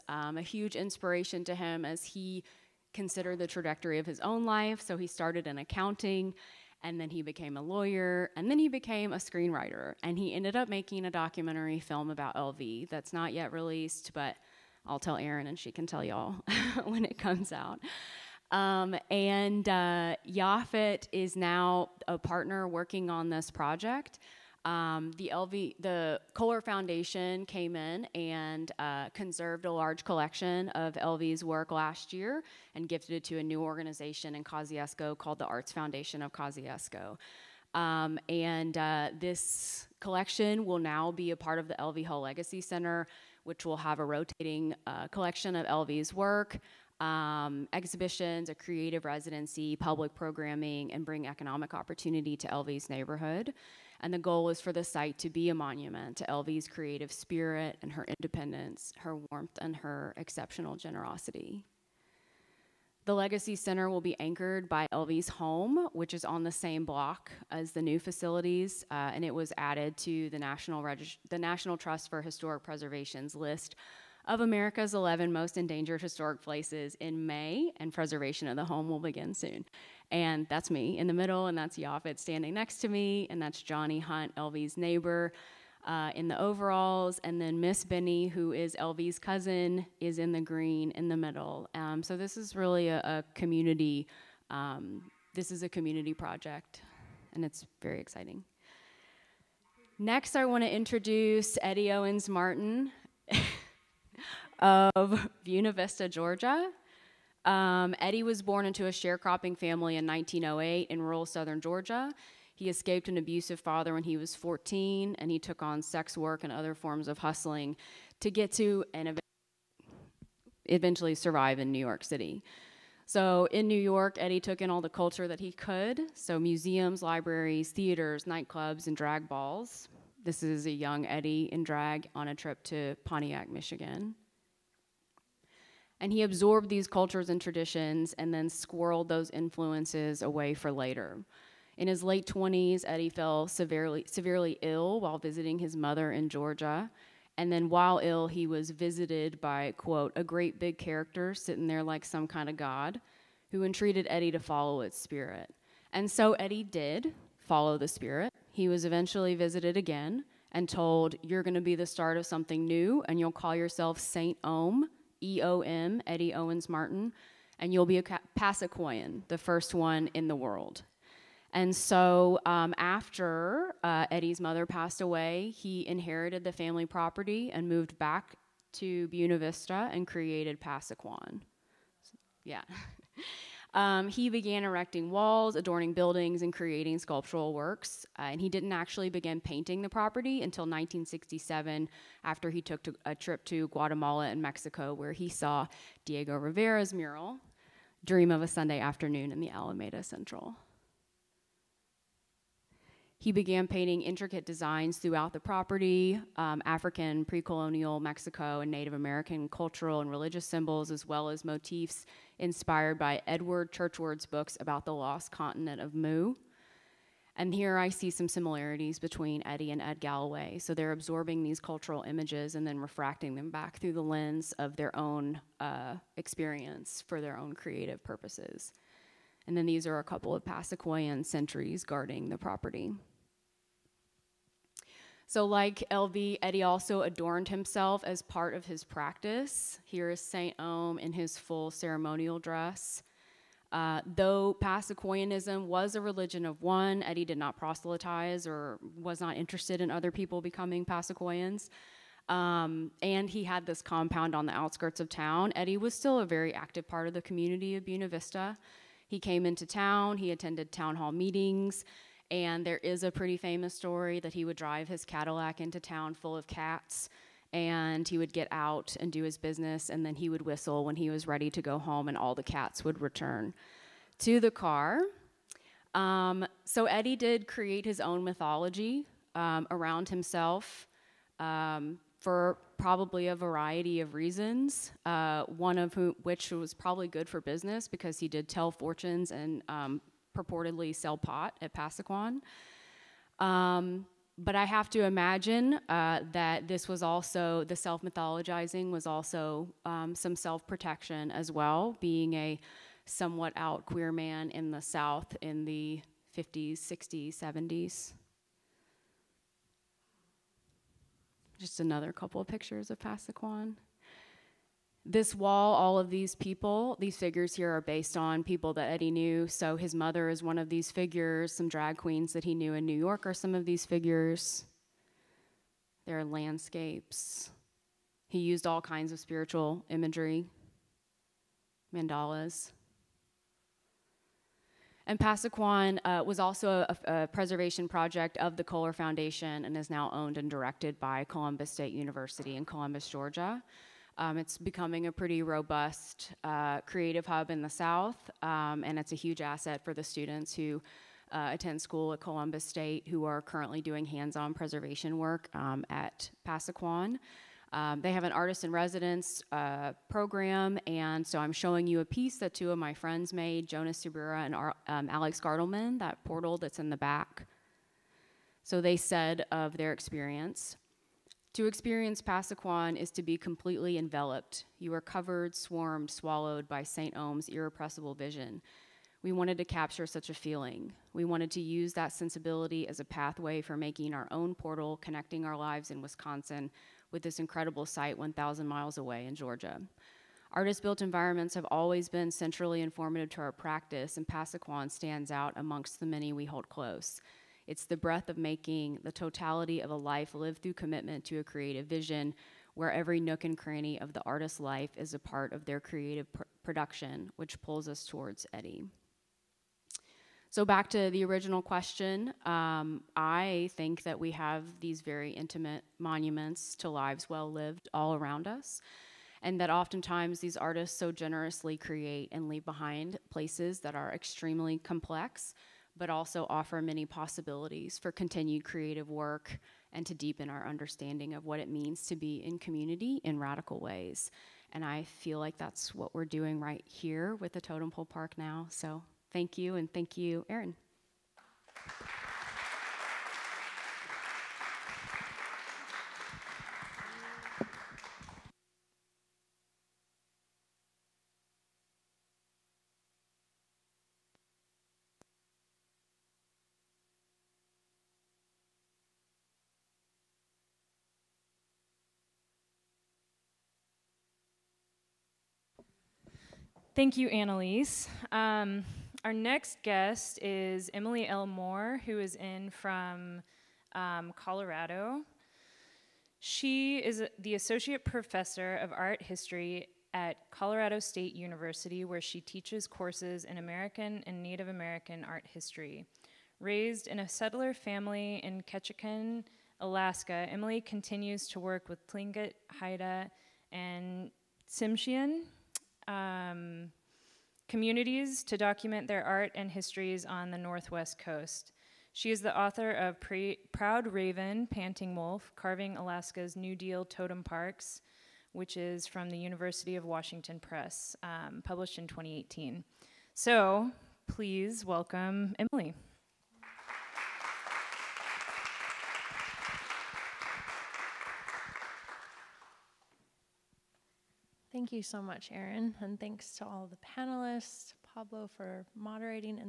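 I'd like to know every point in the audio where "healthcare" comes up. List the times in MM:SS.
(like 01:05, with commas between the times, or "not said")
not said.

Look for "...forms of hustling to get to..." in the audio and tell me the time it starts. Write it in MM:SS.
01:56.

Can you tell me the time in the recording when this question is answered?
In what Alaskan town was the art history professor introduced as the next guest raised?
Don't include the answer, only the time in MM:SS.
08:08.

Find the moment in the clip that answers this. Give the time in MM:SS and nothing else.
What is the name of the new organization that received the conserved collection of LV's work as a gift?
00:35.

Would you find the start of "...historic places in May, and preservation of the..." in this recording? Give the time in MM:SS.
01:15.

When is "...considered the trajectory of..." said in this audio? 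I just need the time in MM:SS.
00:02.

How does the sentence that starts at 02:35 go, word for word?
And so Eddie did follow the spirit.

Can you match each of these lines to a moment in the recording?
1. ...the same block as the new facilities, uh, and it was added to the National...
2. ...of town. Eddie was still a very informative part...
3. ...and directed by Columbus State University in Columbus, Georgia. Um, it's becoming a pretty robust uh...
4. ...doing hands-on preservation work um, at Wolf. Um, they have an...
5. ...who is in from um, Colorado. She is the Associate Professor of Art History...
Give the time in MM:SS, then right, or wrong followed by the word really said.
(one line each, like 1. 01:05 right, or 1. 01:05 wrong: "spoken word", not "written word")
1. 01:06 right
2. 04:14 wrong: "active", not "informative"
3. 05:40 right
4. 05:53 wrong: "Pasaquan", not "Wolf"
5. 07:52 right.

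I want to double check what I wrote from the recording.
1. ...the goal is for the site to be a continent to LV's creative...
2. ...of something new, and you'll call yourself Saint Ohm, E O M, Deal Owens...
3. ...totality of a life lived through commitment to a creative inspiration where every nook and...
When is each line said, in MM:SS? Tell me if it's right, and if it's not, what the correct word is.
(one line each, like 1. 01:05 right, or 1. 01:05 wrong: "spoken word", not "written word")
1. 00:54 wrong: "monument", not "continent"
2. 02:42 wrong: "Eddie", not "Deal"
3. 06:39 wrong: "vision", not "inspiration".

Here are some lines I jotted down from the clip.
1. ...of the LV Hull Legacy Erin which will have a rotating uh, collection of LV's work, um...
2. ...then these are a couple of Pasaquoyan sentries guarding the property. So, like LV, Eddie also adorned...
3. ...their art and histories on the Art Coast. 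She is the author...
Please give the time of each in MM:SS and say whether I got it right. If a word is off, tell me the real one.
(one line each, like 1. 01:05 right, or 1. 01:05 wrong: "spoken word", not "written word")
1. 00:41 wrong: "Center", not "Erin"
2. 03:49 right
3. 08:19 wrong: "Northwest", not "Art".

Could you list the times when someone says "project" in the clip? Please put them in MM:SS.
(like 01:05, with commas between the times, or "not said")
00:23, 01:36, 05:37.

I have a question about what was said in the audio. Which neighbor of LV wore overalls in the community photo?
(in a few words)
Johnny Hunt.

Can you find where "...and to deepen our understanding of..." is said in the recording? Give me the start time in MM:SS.
07:09.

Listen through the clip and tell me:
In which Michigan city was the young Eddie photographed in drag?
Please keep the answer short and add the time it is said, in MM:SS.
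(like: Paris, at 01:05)
Pontiac, at 02:13.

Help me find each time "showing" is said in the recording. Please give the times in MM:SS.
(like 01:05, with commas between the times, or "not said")
06:01.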